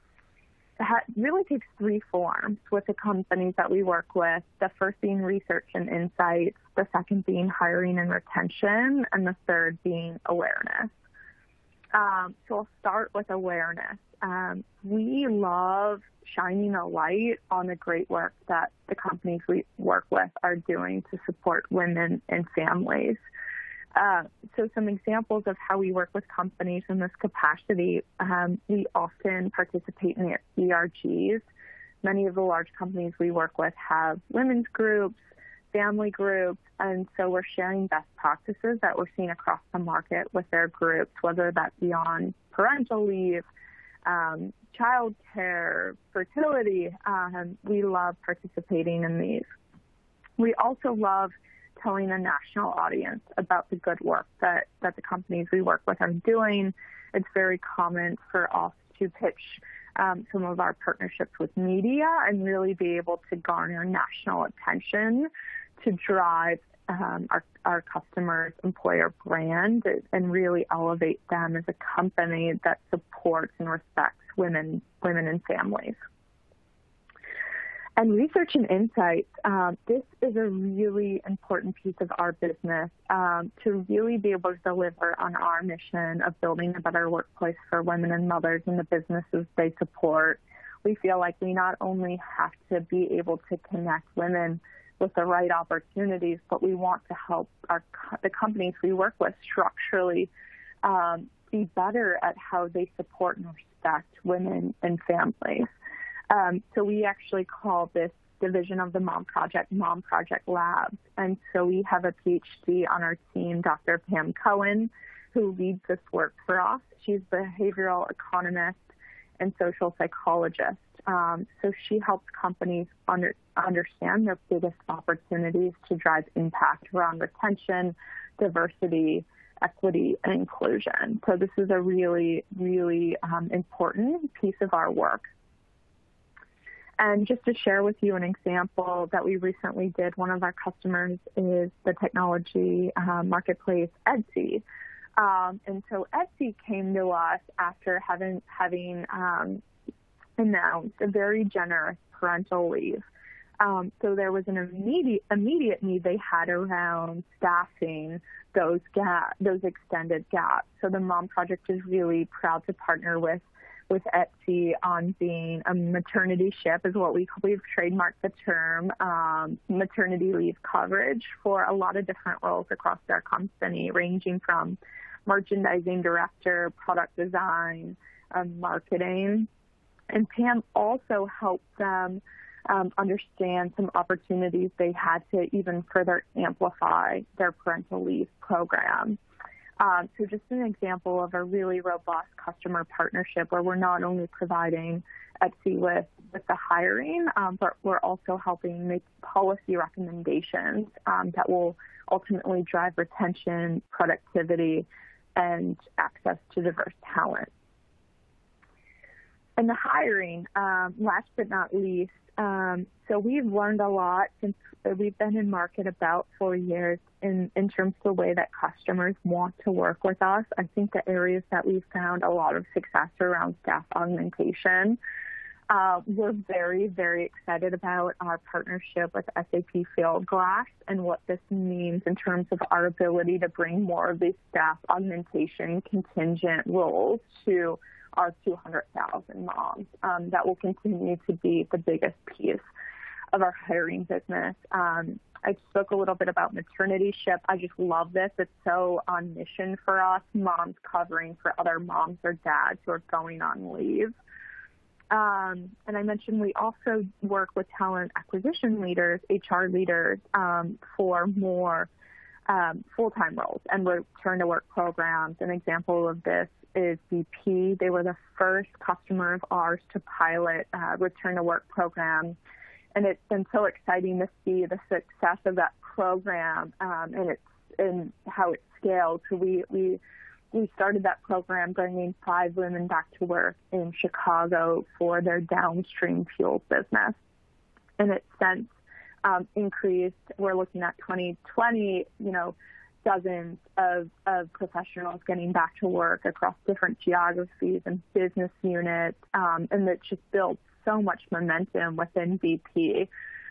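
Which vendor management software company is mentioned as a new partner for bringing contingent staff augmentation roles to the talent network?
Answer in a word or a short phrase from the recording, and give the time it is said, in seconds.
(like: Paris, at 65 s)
SAP Fieldglass, at 229 s.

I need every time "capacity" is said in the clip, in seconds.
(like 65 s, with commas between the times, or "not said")
27 s.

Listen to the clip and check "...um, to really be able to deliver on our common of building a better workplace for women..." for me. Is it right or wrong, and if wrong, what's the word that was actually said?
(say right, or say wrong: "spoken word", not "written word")
wrong: "mission", not "common".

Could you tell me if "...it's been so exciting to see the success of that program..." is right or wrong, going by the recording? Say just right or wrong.
right.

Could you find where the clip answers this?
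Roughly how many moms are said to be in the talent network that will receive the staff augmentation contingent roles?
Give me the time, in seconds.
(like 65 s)
238 s.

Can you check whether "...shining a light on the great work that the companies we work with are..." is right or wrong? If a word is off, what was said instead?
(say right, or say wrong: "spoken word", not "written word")
right.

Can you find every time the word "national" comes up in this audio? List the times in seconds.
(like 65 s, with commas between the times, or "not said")
52 s, 63 s.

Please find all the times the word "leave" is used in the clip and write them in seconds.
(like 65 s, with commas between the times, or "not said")
43 s, 152 s, 170 s, 188 s, 253 s.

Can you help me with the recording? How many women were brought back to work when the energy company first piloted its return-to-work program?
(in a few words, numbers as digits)
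5.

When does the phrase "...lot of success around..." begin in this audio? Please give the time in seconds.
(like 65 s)
222 s.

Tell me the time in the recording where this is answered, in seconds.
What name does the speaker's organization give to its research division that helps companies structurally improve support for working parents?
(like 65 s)
109 s.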